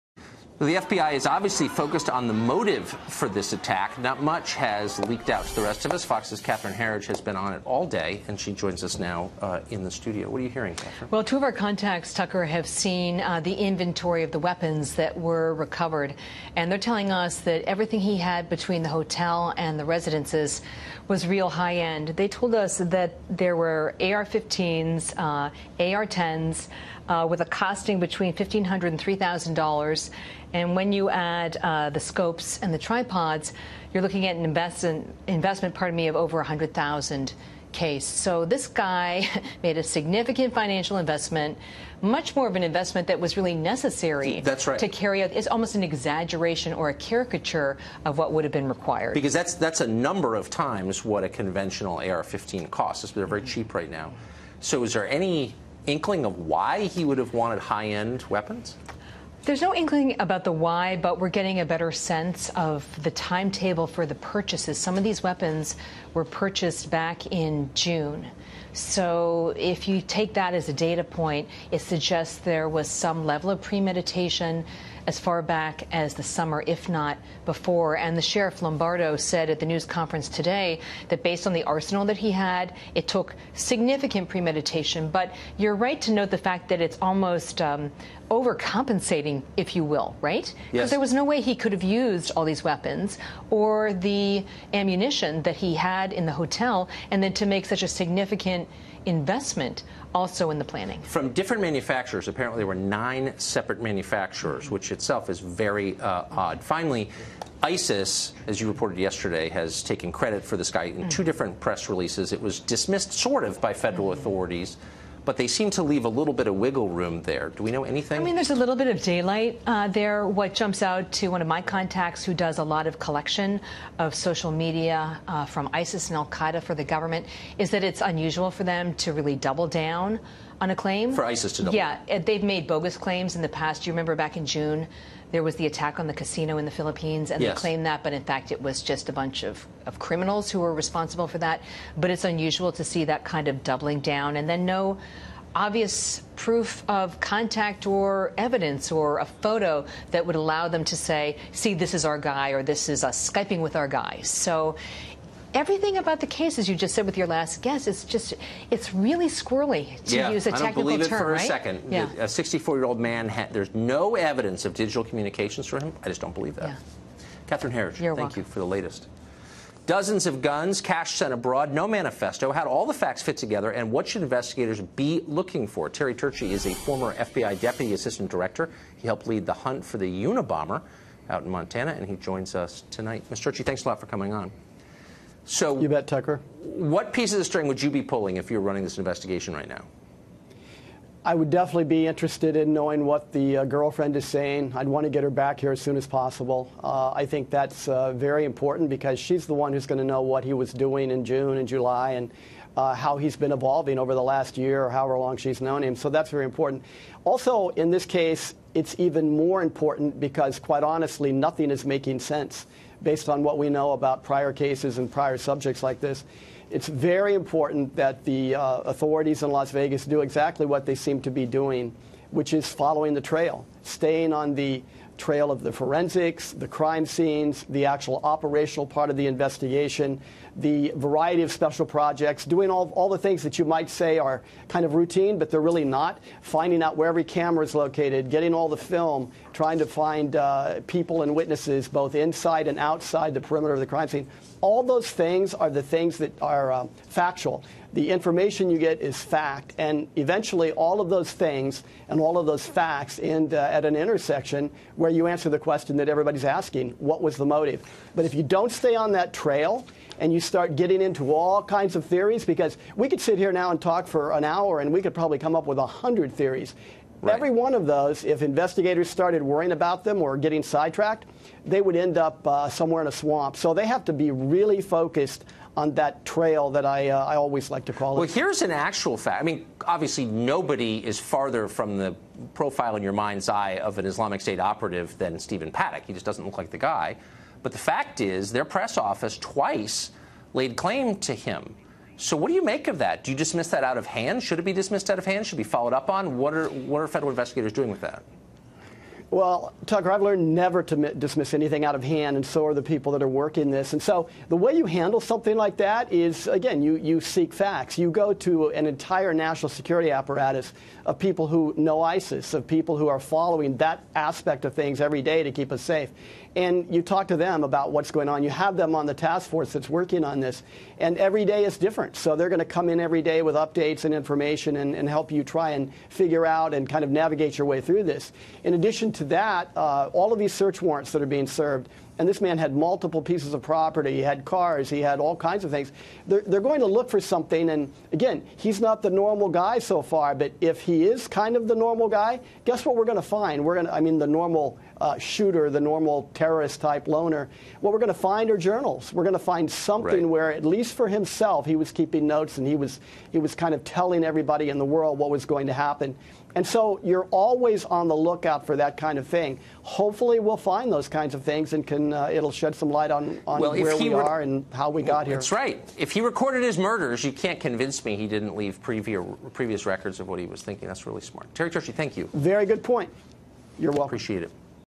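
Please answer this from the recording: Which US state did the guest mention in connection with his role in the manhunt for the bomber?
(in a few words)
Montana.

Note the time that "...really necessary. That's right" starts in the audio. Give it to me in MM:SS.
00:43.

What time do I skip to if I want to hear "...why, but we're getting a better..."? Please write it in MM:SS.
01:00.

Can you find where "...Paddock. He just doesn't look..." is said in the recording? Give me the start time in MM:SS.
04:45.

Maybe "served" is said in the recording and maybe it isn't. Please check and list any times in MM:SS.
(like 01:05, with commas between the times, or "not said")
05:31.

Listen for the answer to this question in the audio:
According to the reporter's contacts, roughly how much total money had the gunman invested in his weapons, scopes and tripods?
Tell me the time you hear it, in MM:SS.
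00:36.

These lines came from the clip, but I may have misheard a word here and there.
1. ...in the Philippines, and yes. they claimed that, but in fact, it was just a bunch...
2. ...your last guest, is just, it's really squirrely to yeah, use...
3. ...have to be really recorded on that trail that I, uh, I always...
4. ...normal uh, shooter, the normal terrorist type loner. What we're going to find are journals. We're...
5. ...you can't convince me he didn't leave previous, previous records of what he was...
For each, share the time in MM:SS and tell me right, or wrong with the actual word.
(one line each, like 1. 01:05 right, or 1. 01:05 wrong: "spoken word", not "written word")
1. 02:16 right
2. 02:37 right
3. 04:33 wrong: "focused", not "recorded"
4. 05:44 right
5. 06:07 right.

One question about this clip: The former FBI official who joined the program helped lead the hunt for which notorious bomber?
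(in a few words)
Unabomber.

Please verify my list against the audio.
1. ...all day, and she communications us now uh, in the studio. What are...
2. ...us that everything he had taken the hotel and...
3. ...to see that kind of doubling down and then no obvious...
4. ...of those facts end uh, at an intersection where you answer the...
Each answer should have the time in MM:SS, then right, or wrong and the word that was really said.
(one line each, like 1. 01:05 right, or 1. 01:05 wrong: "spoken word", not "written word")
1. 00:07 wrong: "joins", not "communications"
2. 00:17 wrong: "between", not "taken"
3. 02:22 right
4. 04:12 right.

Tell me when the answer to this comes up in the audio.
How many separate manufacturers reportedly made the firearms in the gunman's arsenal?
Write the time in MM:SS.
01:42.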